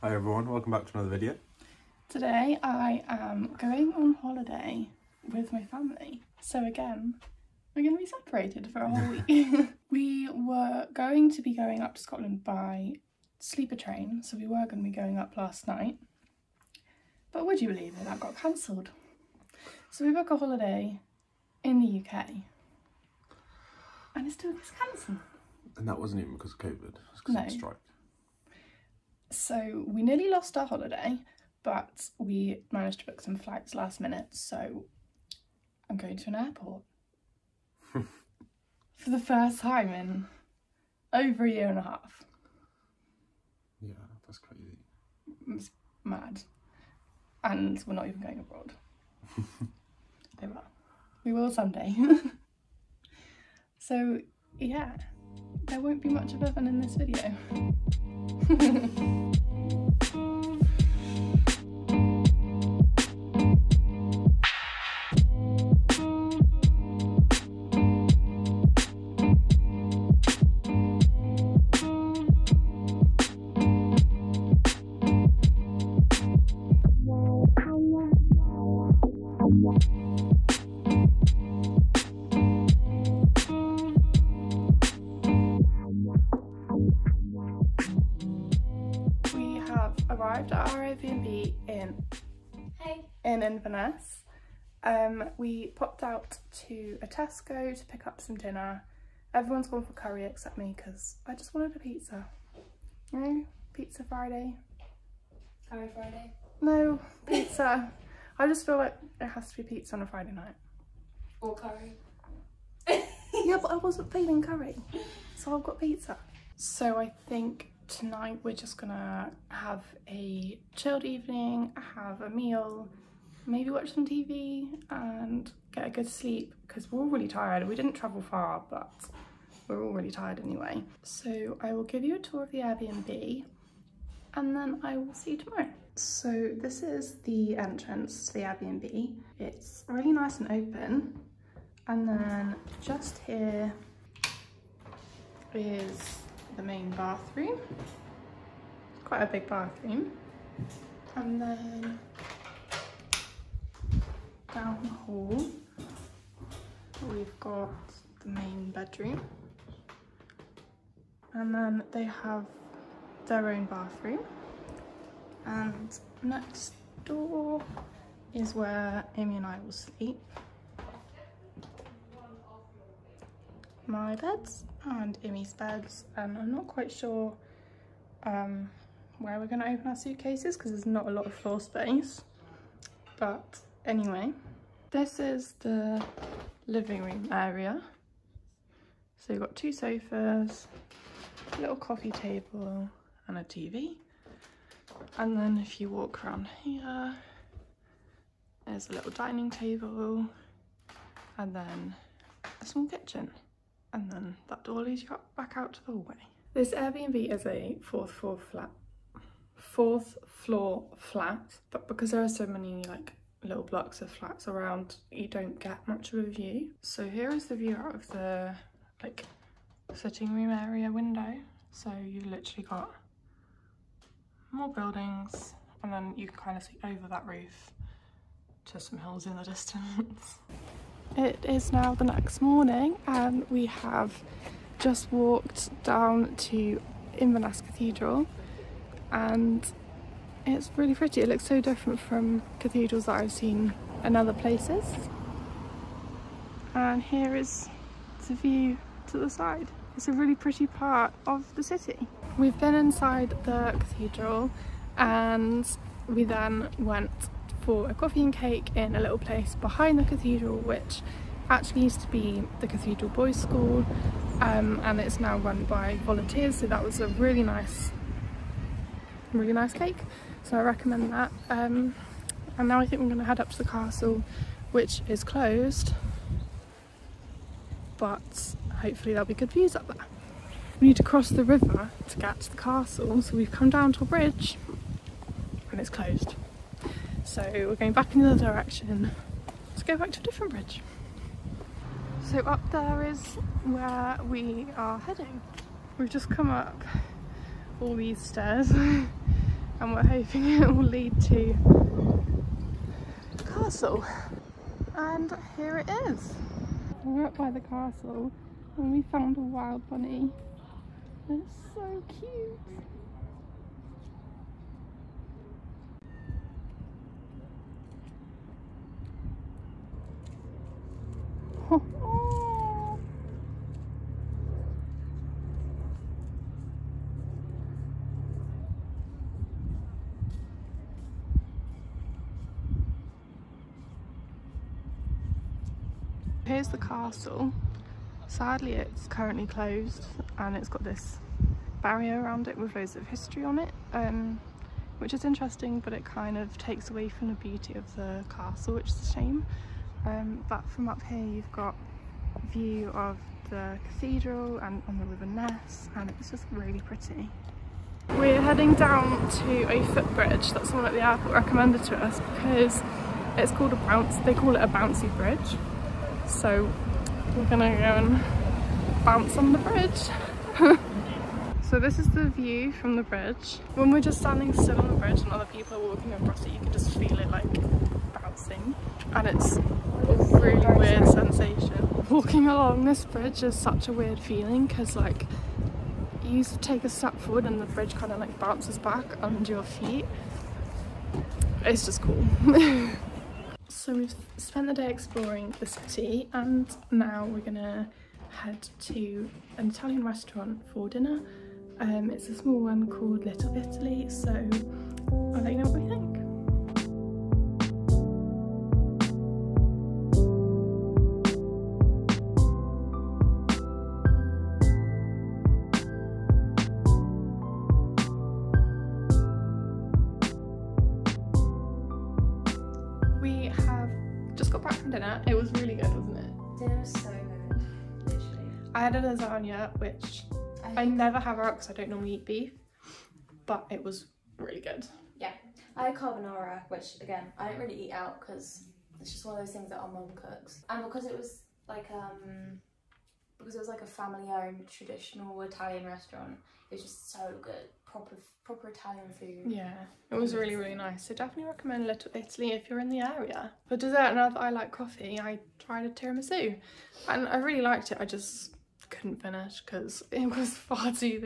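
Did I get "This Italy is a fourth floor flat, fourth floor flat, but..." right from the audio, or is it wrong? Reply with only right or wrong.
wrong.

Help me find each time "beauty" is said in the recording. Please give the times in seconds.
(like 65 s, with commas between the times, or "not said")
347 s.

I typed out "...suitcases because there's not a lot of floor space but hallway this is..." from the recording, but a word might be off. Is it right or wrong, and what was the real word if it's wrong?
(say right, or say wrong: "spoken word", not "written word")
wrong: "anyway", not "hallway".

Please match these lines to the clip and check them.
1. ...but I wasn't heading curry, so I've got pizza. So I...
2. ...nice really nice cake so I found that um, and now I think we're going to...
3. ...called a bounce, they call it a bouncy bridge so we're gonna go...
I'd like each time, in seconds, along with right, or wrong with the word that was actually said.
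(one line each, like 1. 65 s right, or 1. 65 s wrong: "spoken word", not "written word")
1. 113 s wrong: "feeling", not "heading"
2. 267 s wrong: "recommend", not "found"
3. 363 s right.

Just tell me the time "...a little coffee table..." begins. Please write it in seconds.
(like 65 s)
191 s.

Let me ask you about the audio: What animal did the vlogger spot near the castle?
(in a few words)
A wild bunny.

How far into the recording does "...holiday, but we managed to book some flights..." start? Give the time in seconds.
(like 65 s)
30 s.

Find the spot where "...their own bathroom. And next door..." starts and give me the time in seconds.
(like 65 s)
163 s.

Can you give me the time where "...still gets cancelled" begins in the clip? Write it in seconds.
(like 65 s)
24 s.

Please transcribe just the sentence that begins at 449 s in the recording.
Yeah, it was really, really nice.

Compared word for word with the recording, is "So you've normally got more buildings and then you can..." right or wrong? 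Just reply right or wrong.
wrong.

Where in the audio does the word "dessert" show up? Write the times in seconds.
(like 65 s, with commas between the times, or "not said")
453 s.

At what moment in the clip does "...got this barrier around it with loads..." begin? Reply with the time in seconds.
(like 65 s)
340 s.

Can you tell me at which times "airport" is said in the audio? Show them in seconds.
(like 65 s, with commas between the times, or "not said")
36 s, 361 s.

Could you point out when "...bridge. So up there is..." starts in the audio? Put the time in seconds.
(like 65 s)
290 s.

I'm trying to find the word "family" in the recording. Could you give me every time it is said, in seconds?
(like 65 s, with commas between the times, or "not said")
5 s, 443 s.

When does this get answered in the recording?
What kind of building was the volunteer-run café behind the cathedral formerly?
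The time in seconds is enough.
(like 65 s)
262 s.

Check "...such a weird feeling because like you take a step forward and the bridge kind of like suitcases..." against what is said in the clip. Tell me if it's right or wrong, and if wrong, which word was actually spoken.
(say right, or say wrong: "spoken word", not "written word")
wrong: "bounces", not "suitcases".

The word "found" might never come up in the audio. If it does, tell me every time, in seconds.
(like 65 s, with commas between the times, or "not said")
309 s.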